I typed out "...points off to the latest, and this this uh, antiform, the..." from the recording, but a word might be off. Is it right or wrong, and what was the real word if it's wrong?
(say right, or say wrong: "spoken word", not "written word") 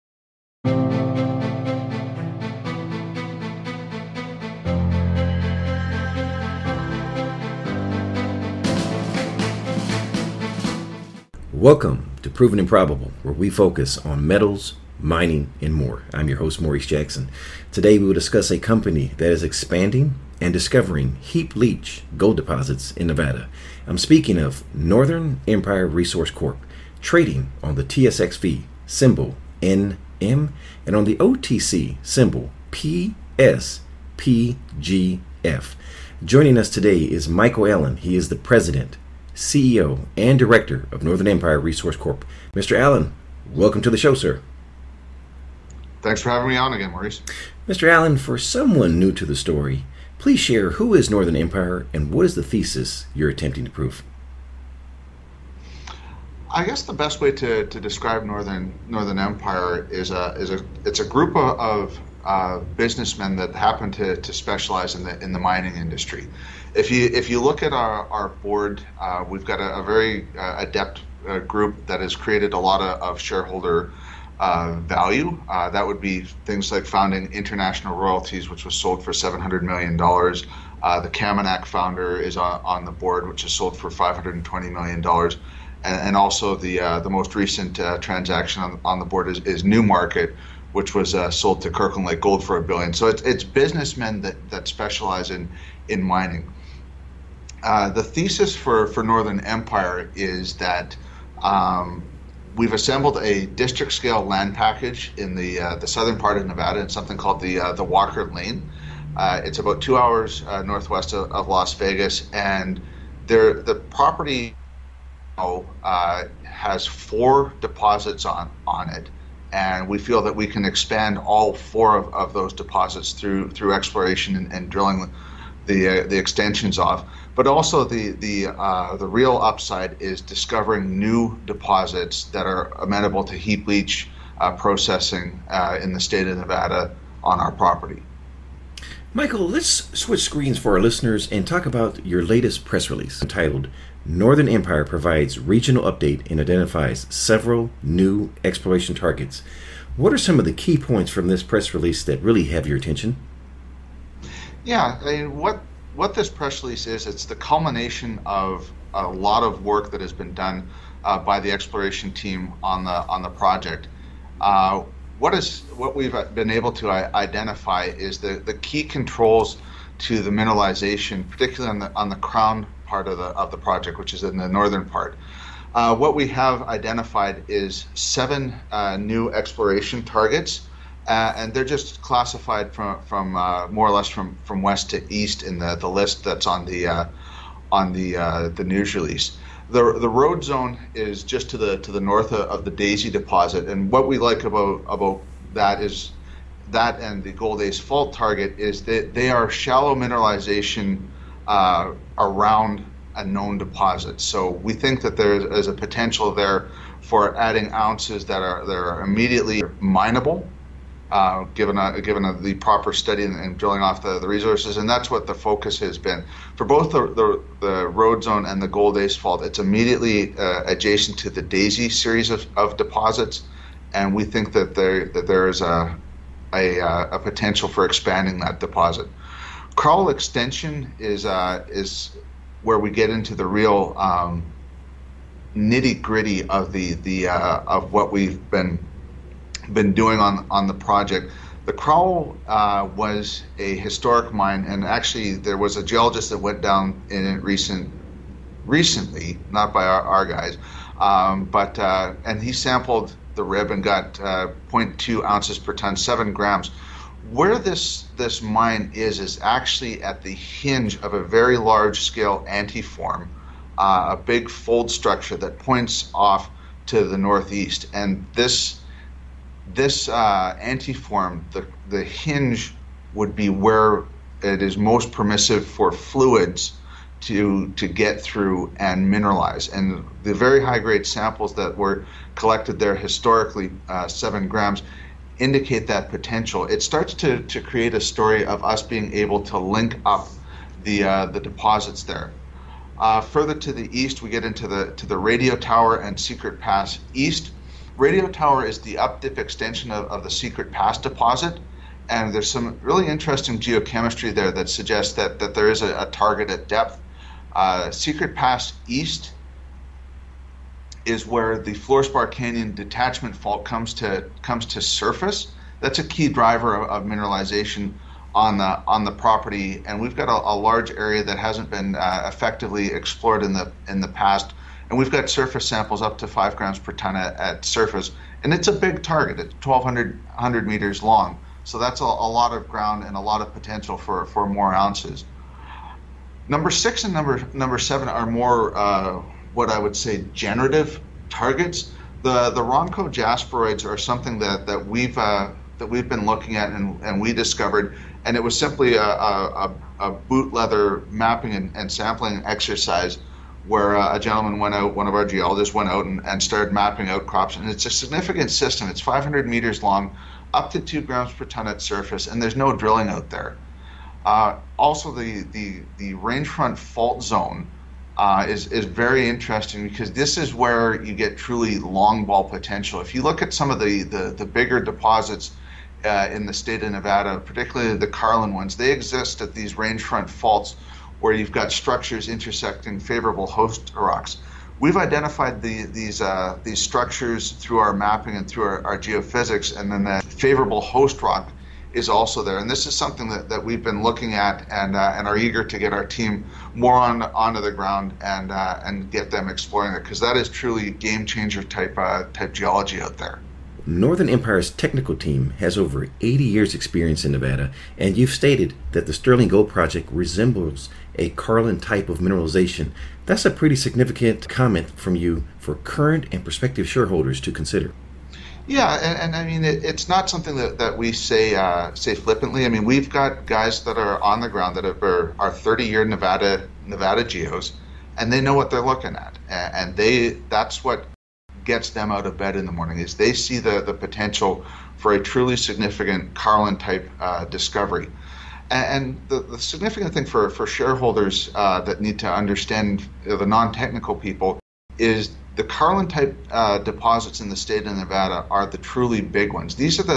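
wrong: "northeast", not "latest".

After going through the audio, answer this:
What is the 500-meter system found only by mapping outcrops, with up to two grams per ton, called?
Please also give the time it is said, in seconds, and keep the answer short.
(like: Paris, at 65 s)
Ronco jasperoids, at 342 s.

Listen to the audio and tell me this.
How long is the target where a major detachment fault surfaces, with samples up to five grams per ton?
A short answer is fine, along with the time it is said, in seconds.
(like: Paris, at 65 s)
1,200 meters, at 329 s.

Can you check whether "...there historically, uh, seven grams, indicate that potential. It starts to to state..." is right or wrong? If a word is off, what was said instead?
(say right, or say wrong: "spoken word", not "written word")
wrong: "create", not "state".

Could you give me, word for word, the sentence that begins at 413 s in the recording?
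That's a pretty significant comment from you for current and prospective shareholders to consider.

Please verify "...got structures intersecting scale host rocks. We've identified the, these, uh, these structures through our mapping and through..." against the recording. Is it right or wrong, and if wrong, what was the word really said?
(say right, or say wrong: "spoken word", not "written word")
wrong: "favorable", not "scale".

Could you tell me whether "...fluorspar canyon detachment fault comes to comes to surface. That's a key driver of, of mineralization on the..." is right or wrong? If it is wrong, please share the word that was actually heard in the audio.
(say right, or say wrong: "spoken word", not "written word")
right.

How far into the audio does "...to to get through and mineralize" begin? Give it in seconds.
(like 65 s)
277 s.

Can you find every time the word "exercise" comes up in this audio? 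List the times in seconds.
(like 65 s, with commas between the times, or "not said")
352 s.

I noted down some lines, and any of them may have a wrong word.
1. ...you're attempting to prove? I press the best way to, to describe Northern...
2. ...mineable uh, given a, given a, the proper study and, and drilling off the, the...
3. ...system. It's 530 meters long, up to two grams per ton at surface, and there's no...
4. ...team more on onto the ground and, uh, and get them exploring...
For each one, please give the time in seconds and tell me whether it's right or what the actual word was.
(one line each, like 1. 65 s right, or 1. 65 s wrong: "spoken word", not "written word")
1. 53 s wrong: "guess", not "press"
2. 209 s right
3. 358 s wrong: "500", not "530"
4. 396 s right.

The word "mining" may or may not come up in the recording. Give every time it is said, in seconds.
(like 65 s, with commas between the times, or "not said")
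14 s, 65 s, 96 s.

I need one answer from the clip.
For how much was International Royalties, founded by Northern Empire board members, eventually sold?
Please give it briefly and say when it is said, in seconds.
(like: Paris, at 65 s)
700 million dollars, at 79 s.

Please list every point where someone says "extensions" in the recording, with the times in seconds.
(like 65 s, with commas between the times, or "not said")
126 s, 230 s, 299 s.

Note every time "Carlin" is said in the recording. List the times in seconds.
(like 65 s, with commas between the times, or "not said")
378 s, 411 s, 436 s, 445 s.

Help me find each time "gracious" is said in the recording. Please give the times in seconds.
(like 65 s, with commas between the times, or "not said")
not said.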